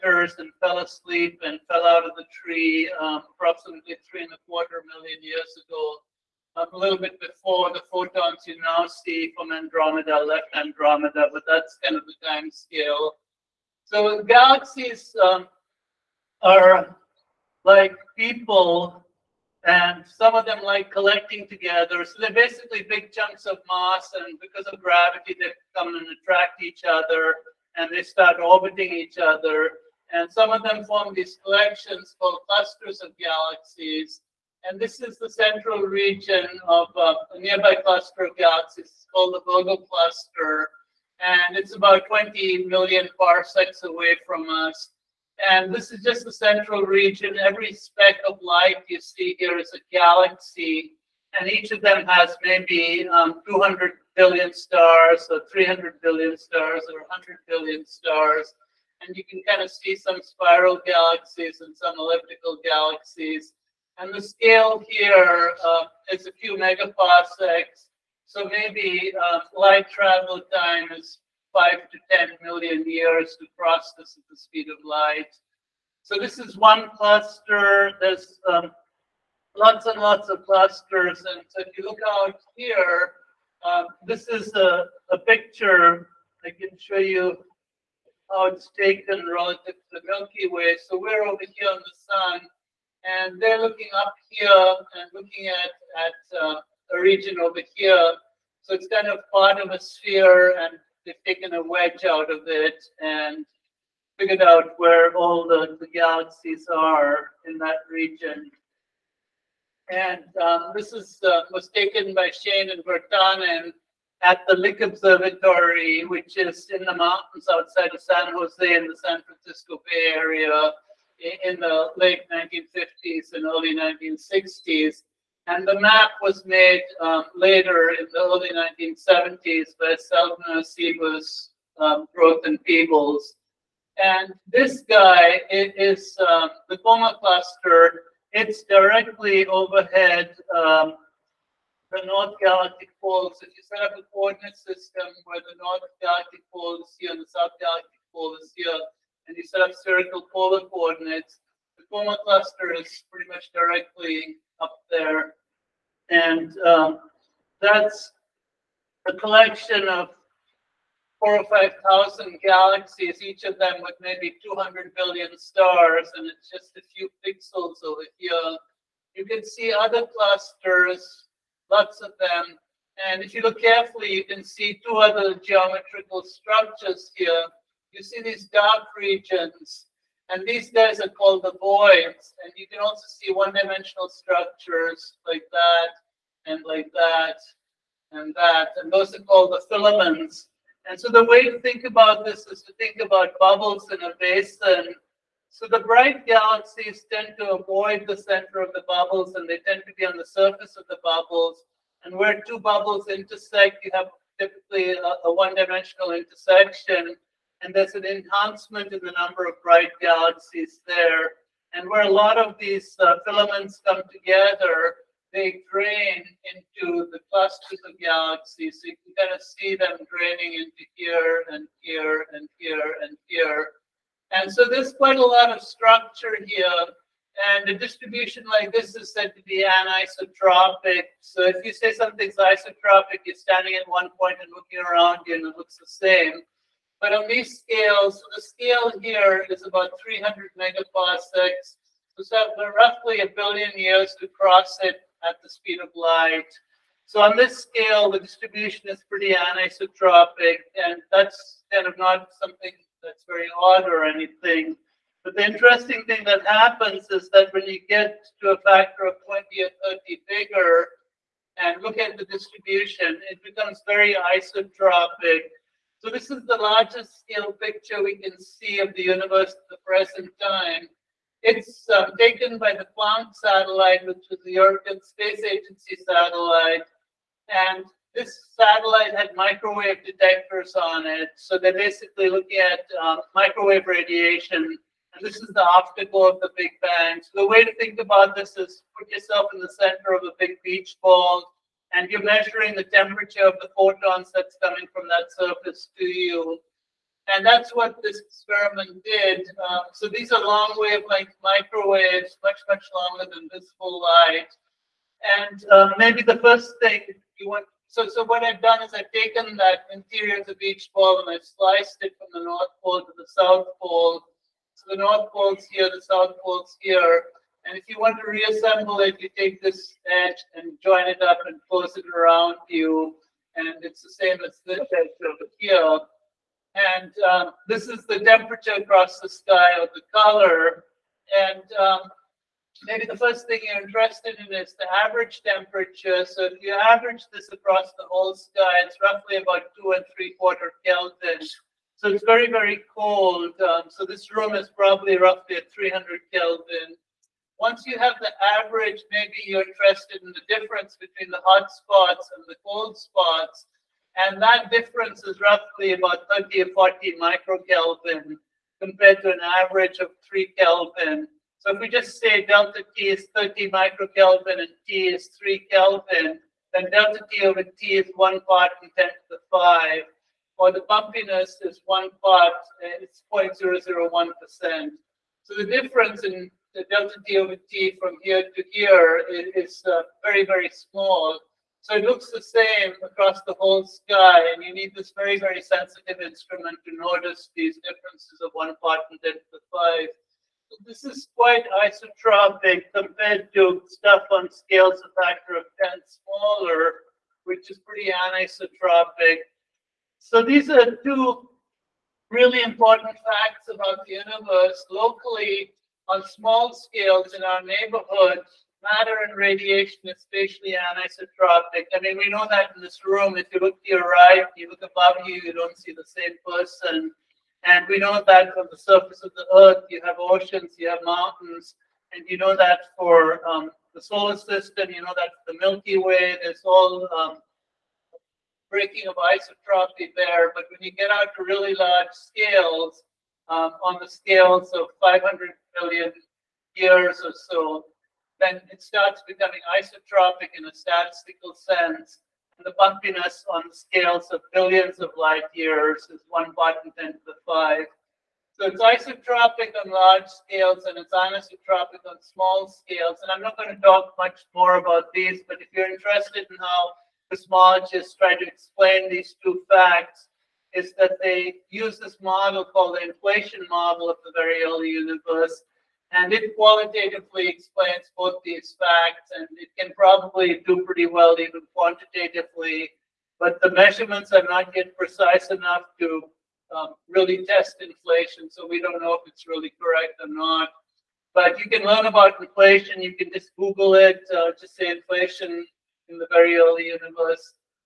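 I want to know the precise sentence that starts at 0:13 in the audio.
So galaxies um, are like people and some of them like collecting together.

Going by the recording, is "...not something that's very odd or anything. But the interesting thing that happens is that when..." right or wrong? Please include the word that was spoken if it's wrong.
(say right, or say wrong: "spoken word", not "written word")
right.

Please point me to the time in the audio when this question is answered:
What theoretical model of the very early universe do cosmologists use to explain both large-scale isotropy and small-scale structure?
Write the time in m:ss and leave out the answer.
7:43.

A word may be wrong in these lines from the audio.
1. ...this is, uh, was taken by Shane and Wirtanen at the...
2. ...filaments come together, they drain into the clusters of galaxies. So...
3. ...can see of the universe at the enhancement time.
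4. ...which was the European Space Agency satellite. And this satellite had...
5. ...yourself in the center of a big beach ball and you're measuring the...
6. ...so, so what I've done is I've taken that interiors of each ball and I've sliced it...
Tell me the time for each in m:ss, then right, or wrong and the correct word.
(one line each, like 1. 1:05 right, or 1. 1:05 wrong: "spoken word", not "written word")
1. 1:50 right
2. 3:33 right
3. 4:28 wrong: "present", not "enhancement"
4. 4:34 right
5. 4:49 right
6. 5:07 right.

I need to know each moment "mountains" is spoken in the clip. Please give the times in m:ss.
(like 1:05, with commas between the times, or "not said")
1:56, 7:01.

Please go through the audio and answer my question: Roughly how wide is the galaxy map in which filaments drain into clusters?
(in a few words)
300 megaparsecs.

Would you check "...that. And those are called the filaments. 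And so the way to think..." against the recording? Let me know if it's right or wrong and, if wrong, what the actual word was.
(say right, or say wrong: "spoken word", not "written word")
right.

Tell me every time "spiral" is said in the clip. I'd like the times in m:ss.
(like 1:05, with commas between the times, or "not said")
1:00.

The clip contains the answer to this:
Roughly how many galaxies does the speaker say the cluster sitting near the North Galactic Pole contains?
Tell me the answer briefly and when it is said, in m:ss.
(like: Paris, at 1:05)
4,000 or 5,000, at 2:41.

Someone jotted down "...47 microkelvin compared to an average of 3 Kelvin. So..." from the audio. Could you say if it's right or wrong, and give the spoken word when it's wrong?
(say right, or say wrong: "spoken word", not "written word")
wrong: "40", not "47".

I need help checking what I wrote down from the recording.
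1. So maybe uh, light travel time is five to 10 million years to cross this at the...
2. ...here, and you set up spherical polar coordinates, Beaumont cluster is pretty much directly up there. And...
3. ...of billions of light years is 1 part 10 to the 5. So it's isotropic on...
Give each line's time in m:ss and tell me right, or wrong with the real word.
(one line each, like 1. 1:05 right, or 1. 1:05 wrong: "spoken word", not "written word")
1. 1:08 right
2. 2:28 right
3. 7:24 right.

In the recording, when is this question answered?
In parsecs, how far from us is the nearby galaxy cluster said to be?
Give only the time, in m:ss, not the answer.
0:42.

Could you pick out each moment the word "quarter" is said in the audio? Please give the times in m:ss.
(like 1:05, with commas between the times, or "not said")
0:04, 5:40.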